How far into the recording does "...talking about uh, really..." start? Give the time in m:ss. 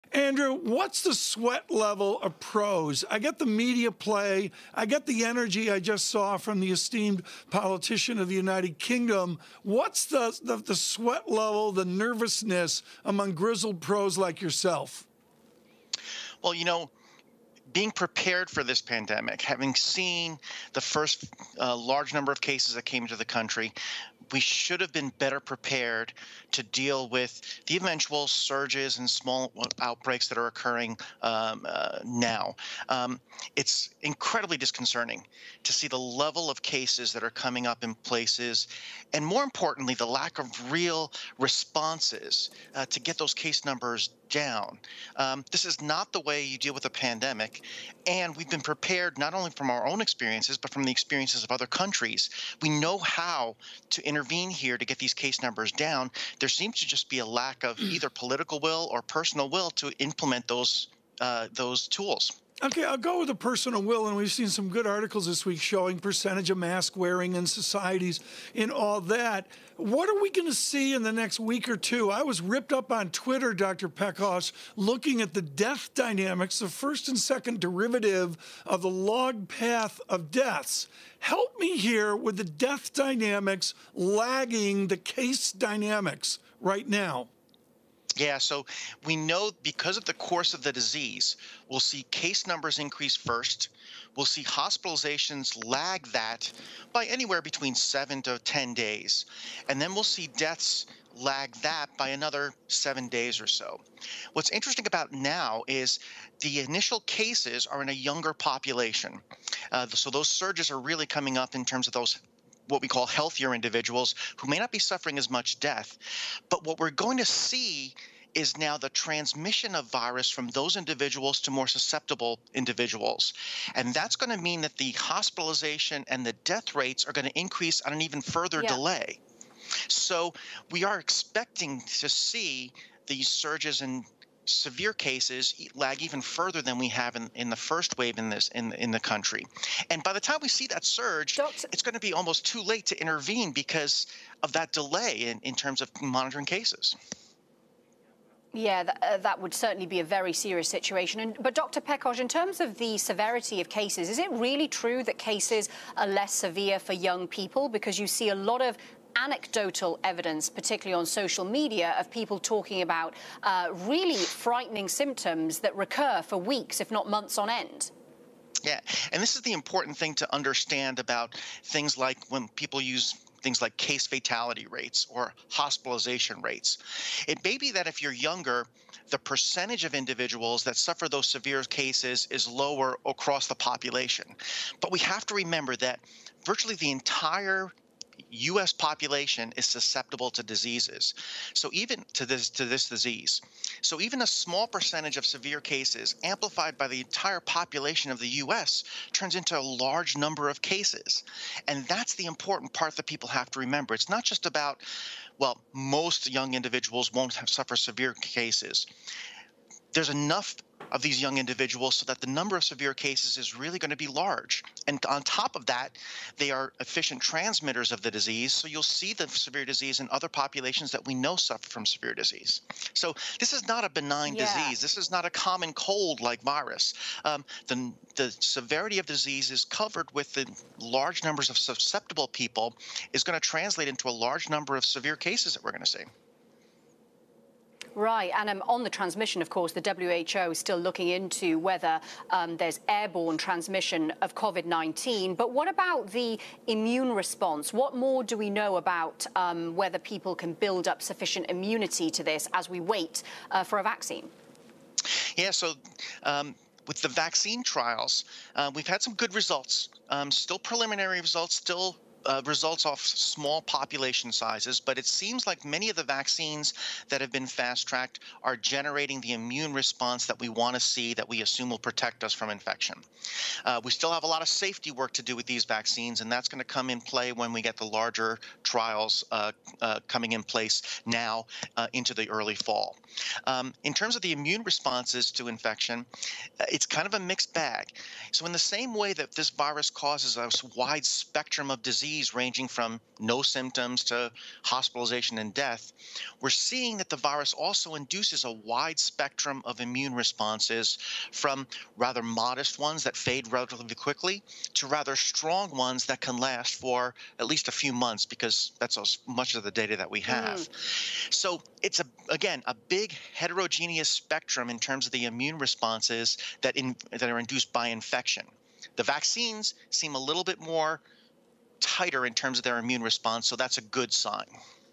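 2:42.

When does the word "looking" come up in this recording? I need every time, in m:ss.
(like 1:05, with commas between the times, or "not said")
1:14, 4:00.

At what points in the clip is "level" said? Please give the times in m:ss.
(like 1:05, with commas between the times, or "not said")
0:01, 0:11, 0:35.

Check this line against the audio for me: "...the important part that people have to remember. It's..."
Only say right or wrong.
right.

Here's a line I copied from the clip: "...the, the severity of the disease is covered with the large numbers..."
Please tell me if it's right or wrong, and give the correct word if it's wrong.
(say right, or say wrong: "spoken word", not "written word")
right.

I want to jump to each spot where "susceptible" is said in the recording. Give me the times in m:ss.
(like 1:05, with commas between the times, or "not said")
2:01, 3:09, 3:51.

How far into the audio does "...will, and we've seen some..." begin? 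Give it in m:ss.
1:03.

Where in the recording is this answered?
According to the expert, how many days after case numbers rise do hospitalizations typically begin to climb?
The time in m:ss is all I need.
1:37.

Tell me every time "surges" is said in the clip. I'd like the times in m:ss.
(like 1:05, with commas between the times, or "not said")
0:28, 1:50, 2:13, 2:20.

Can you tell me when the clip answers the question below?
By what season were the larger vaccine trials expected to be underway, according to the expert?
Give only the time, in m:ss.
4:42.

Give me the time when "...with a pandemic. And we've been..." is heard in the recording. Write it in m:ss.
0:46.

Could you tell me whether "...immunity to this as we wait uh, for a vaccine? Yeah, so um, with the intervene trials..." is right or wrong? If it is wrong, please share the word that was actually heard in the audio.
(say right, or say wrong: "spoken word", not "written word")
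wrong: "vaccine", not "intervene".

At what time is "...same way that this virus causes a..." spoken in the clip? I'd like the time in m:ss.
4:48.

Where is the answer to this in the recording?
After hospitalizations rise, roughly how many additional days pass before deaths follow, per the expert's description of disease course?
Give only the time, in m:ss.
1:42.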